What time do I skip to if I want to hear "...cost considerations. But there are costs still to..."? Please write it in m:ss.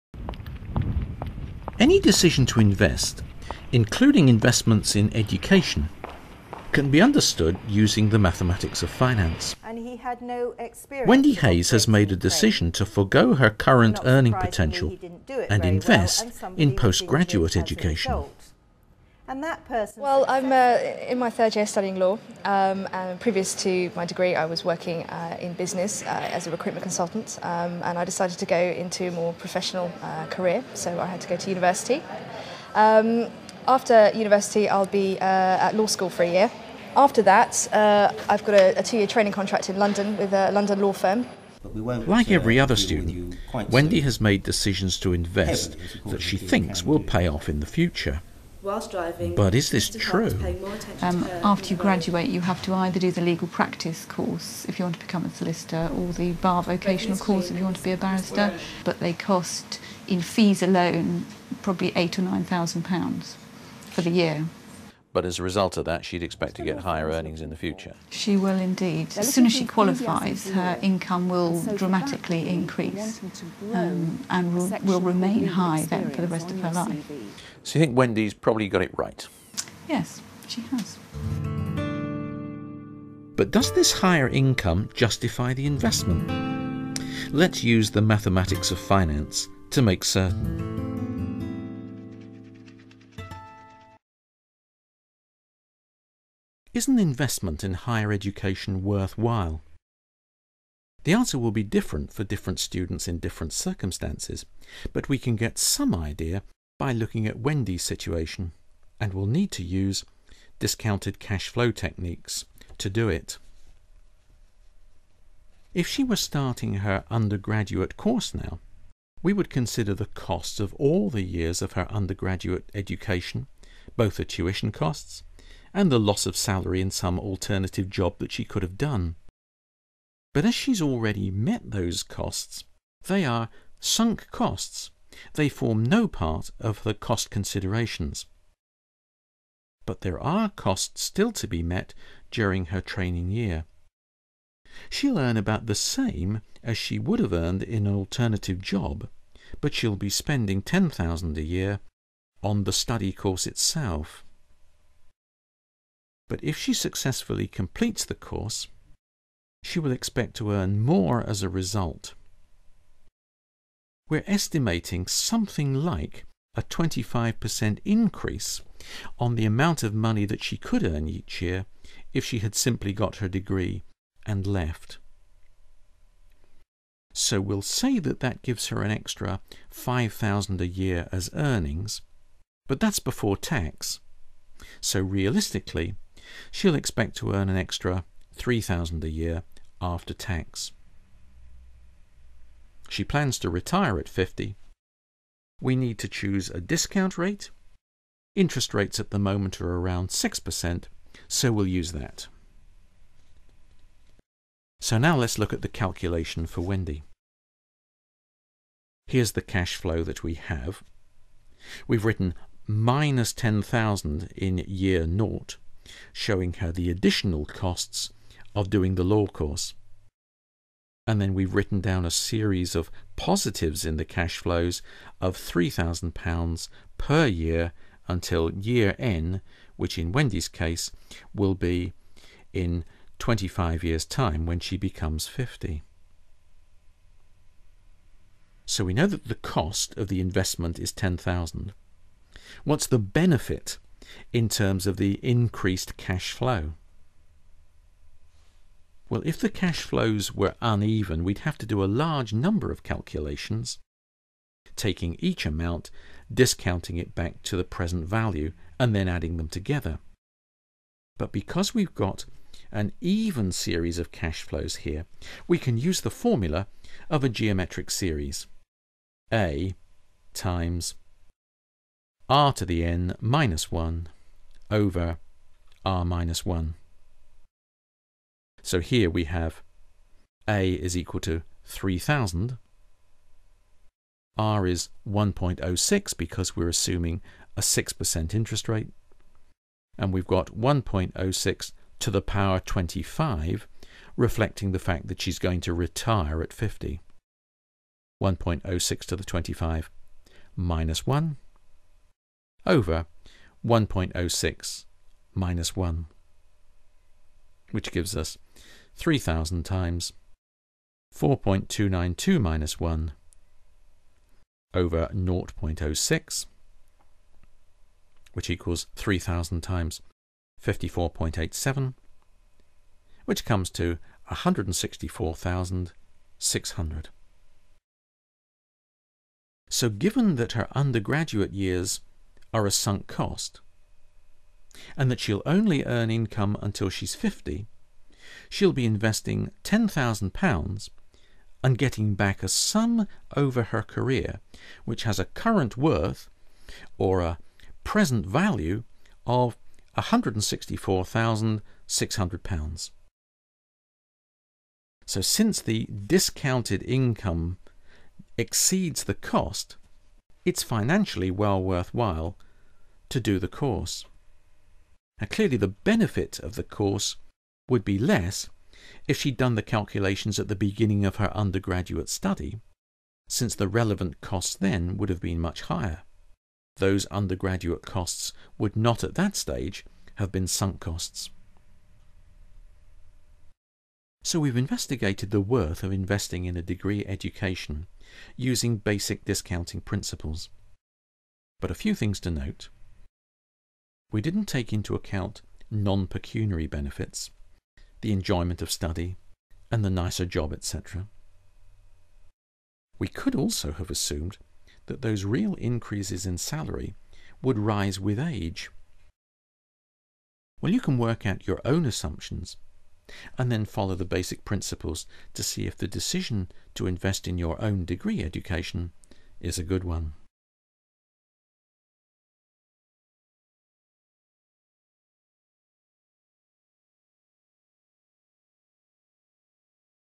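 2:16.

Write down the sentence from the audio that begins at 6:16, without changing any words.
Those undergraduate costs would not at that stage have been sunk costs.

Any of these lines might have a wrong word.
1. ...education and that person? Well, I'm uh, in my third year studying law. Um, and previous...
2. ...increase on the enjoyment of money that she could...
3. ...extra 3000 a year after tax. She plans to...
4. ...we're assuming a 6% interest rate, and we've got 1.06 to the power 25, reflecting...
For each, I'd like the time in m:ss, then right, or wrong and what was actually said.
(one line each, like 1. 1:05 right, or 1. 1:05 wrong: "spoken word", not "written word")
1. 0:17 right
2. 2:47 wrong: "amount", not "enjoyment"
3. 3:07 right
4. 4:46 right.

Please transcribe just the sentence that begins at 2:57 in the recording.
So we'll say that that gives her an extra 5,000 a year as earnings, but that's before tax.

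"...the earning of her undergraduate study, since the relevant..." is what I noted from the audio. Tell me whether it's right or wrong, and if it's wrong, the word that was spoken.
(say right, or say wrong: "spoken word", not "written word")
wrong: "beginning", not "earning".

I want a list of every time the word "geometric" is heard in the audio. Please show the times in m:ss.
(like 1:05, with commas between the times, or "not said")
4:27.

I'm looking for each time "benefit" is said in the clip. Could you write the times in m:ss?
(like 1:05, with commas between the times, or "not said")
4:02, 6:05, 6:36.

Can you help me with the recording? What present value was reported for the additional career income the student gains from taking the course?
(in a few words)
£164,600.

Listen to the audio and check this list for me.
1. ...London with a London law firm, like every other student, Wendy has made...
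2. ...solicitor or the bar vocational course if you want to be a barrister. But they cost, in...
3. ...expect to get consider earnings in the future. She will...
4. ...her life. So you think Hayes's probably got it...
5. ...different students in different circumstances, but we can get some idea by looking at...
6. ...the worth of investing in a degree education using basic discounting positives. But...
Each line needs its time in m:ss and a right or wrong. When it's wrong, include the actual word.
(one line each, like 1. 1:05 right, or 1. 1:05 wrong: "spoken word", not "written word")
1. 0:39 right
2. 0:55 right
3. 1:06 wrong: "higher", not "consider"
4. 1:16 wrong: "Wendy", not "Hayes"
5. 1:42 right
6. 6:25 wrong: "principles", not "positives".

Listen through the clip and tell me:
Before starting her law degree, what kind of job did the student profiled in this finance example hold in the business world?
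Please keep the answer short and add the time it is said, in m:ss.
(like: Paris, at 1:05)
Recruitment consultant, at 0:26.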